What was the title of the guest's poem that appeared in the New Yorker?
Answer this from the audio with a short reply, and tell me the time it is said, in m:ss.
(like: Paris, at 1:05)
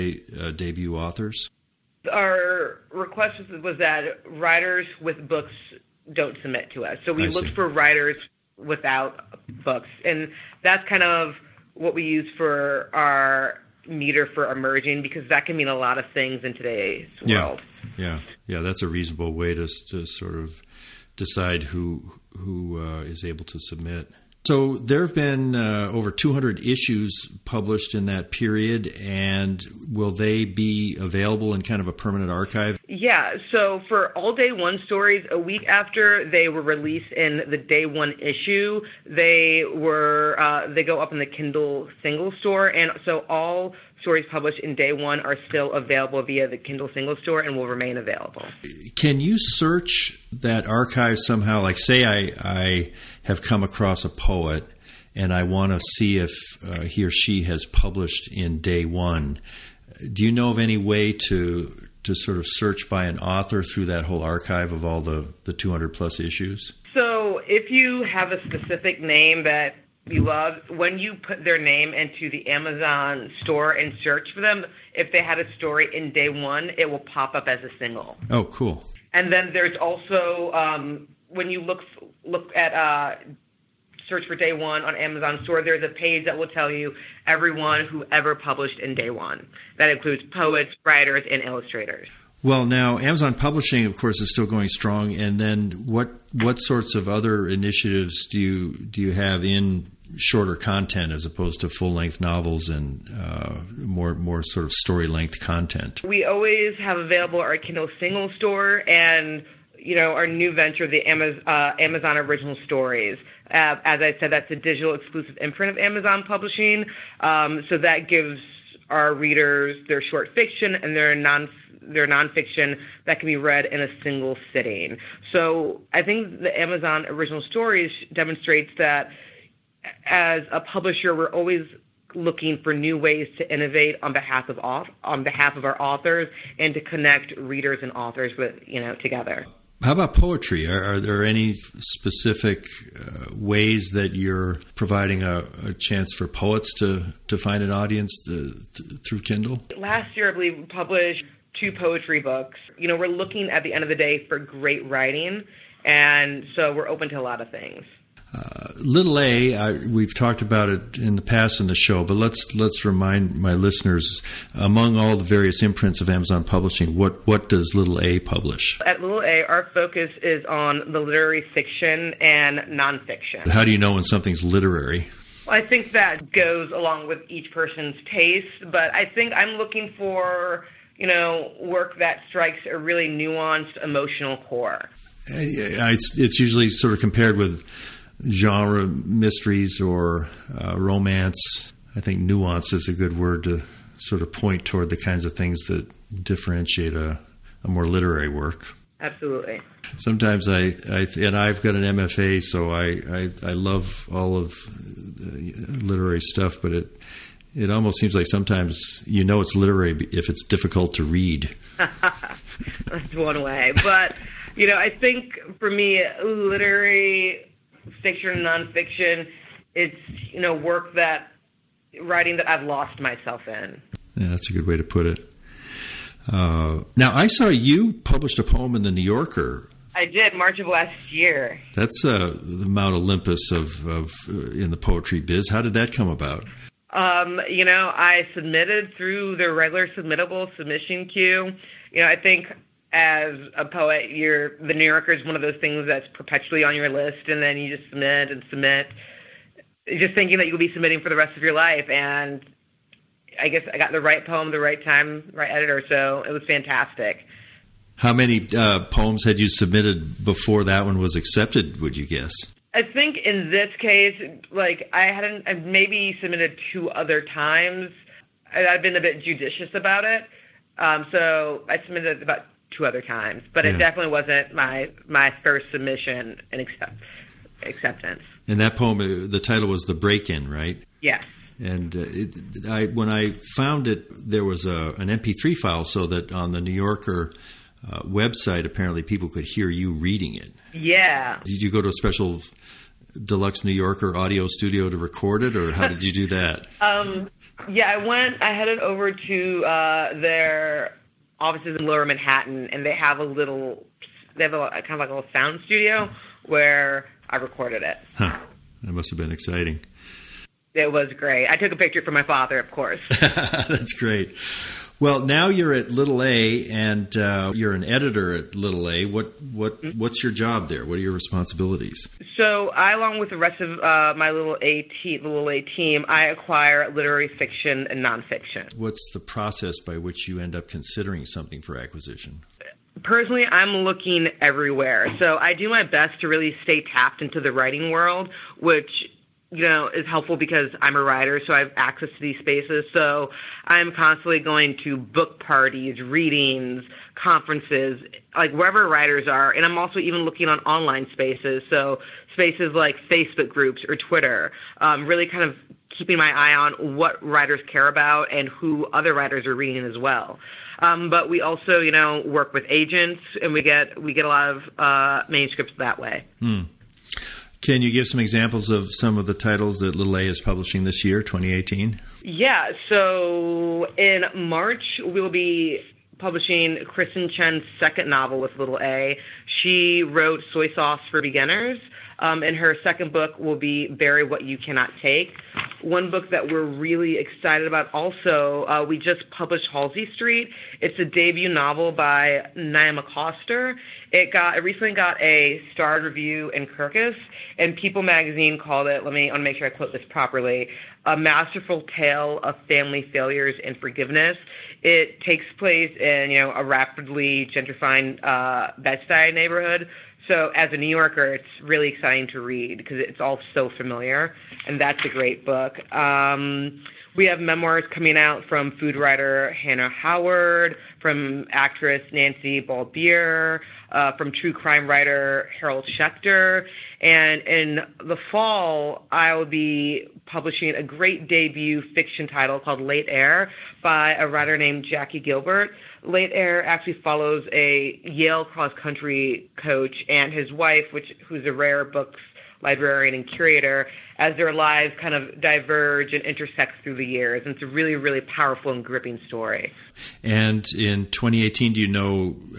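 The Break In, at 4:39.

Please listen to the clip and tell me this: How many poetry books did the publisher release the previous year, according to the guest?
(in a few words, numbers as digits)
2.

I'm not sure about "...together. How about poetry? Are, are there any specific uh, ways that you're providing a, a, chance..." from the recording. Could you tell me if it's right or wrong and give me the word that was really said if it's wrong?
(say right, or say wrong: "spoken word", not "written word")
right.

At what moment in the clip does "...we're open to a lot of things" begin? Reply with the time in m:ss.
2:36.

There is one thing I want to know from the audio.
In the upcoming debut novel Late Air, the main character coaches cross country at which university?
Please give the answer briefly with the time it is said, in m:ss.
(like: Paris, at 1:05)
Yale, at 7:18.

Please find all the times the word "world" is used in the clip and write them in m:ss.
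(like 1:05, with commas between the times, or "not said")
0:17, 5:37.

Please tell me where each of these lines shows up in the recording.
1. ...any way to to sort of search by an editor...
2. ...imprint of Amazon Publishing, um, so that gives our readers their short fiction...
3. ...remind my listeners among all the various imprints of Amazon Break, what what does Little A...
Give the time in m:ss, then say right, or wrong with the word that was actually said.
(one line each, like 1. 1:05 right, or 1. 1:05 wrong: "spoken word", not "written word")
1. 1:00 wrong: "author", not "editor"
2. 1:55 right
3. 2:42 wrong: "Publishing", not "Break".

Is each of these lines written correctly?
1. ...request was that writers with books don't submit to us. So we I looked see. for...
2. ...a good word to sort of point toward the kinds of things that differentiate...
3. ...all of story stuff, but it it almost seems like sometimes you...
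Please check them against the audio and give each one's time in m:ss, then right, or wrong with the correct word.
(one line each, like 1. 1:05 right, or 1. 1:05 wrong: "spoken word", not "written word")
1. 0:02 right
2. 3:12 right
3. 3:24 wrong: "literary", not "story".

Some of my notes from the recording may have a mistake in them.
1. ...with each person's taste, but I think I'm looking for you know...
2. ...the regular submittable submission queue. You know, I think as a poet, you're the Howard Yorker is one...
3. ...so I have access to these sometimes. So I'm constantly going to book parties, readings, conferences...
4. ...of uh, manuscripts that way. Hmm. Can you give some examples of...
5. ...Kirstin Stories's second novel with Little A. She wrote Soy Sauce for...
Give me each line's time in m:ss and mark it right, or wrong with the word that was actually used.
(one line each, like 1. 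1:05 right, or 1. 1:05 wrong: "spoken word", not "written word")
1. 2:57 right
2. 3:59 wrong: "New", not "Howard"
3. 5:41 wrong: "spaces", not "sometimes"
4. 6:04 right
5. 6:16 wrong: "Chen", not "Stories".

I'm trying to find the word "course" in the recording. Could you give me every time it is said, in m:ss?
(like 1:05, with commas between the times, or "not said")
1:33, 5:12.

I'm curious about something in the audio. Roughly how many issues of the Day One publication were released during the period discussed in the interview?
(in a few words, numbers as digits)
over 200.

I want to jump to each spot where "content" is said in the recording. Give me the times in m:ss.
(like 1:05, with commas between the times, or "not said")
1:40, 1:45.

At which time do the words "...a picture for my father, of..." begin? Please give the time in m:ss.
5:11.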